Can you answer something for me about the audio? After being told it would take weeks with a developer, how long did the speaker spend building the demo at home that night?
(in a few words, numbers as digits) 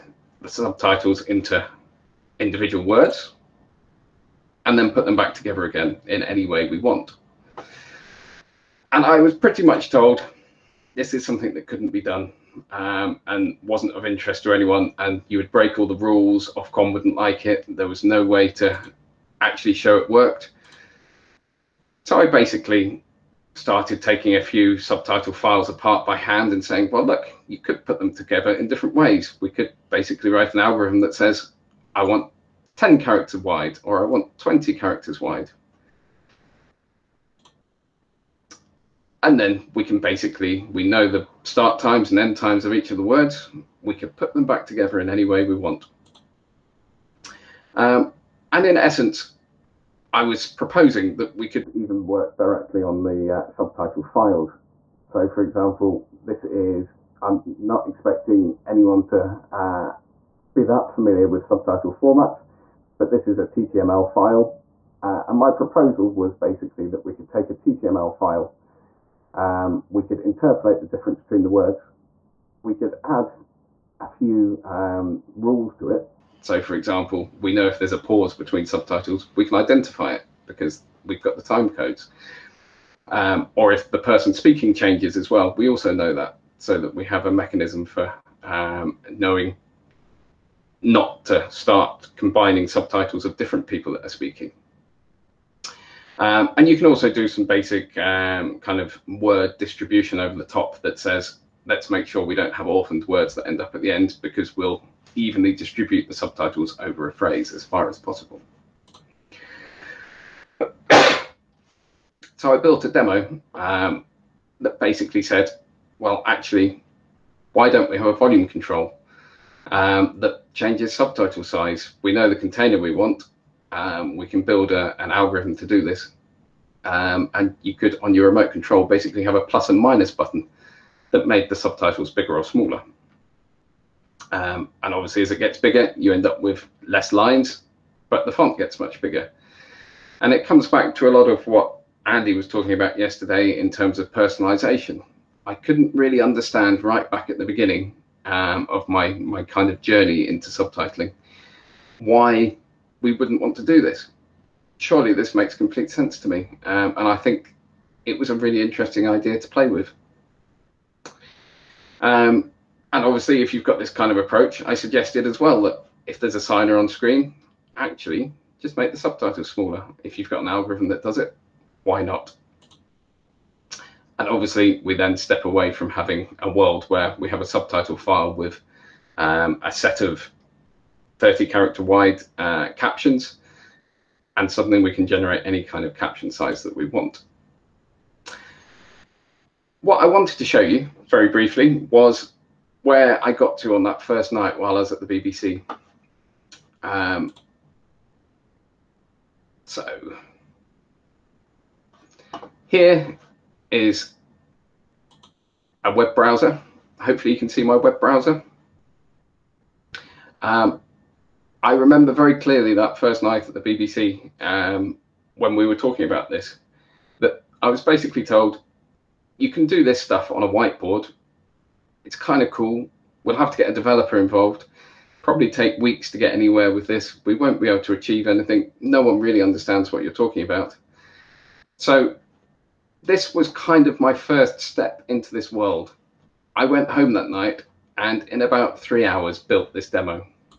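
3 hours.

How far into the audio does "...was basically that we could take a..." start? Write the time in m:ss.
1:06.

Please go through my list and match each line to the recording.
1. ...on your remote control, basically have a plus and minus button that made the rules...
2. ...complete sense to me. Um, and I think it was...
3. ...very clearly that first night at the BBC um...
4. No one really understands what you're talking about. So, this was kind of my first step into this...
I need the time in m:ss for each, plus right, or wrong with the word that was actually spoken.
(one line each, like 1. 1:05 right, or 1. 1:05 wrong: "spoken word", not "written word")
1. 2:08 wrong: "subtitles", not "rules"
2. 2:35 right
3. 3:32 right
4. 3:48 right.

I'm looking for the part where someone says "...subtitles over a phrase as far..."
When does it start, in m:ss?
1:46.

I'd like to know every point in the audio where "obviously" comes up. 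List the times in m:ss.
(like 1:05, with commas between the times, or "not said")
2:14, 2:43, 2:54.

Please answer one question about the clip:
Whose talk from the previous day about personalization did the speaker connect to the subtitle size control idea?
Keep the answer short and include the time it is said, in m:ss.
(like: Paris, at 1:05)
Andy, at 2:22.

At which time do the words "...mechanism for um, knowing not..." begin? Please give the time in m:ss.
1:27.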